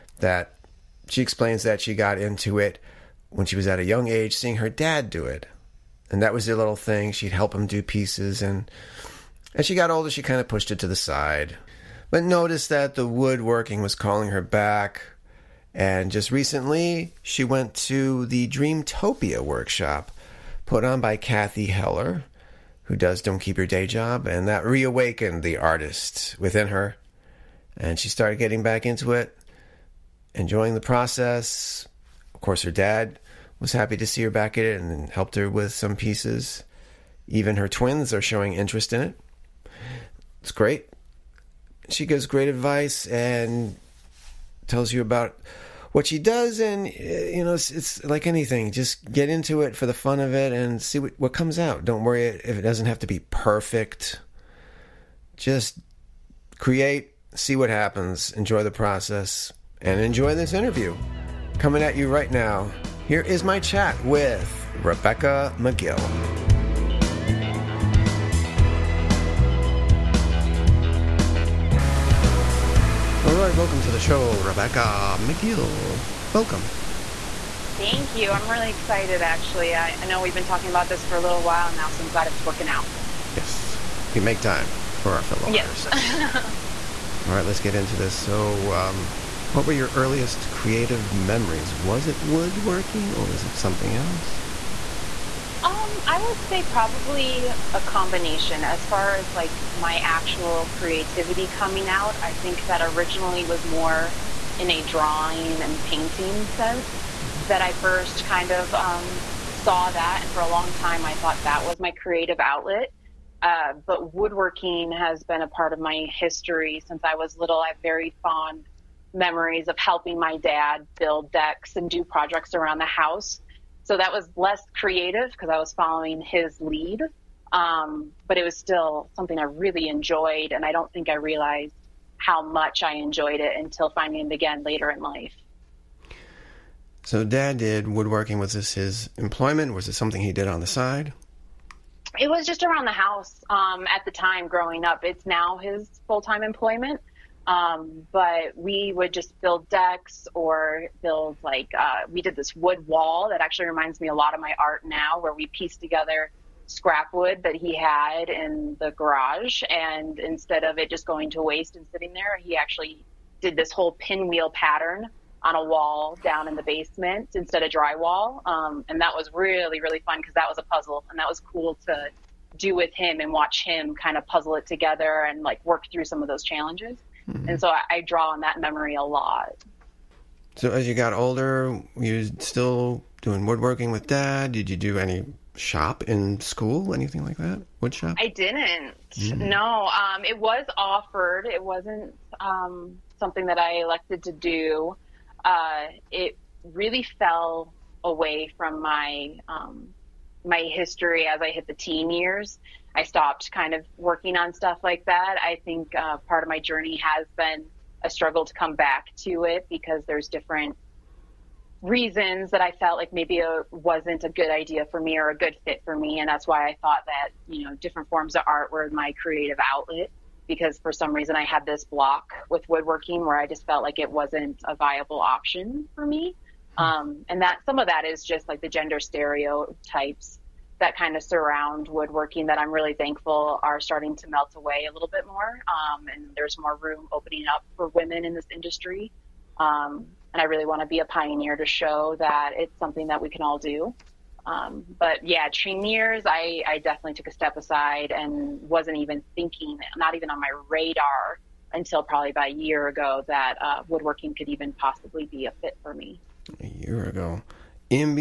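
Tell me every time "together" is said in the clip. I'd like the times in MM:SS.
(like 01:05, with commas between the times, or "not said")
02:35, 02:54.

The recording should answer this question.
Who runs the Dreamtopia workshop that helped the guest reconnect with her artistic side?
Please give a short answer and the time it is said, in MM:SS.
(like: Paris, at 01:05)
Cathy Heller, at 00:21.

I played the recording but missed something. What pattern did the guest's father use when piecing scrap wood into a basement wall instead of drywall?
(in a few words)
Pinwheel.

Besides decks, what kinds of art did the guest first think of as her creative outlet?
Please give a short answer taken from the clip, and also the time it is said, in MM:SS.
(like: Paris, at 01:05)
Drawing and painting, at 01:44.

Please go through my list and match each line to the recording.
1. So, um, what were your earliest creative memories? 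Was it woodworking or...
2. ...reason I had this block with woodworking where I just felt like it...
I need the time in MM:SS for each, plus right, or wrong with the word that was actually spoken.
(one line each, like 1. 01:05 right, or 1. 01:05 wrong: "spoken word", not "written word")
1. 01:28 right
2. 03:41 right.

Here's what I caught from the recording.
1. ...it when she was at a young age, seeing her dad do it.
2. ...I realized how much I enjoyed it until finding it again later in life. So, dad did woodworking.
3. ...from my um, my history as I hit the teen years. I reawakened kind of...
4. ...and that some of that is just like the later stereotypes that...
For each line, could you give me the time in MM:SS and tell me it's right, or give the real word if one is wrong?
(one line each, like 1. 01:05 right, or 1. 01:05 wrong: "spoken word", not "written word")
1. 00:02 right
2. 02:11 right
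3. 03:18 wrong: "stopped", not "reawakened"
4. 03:47 wrong: "gender", not "later".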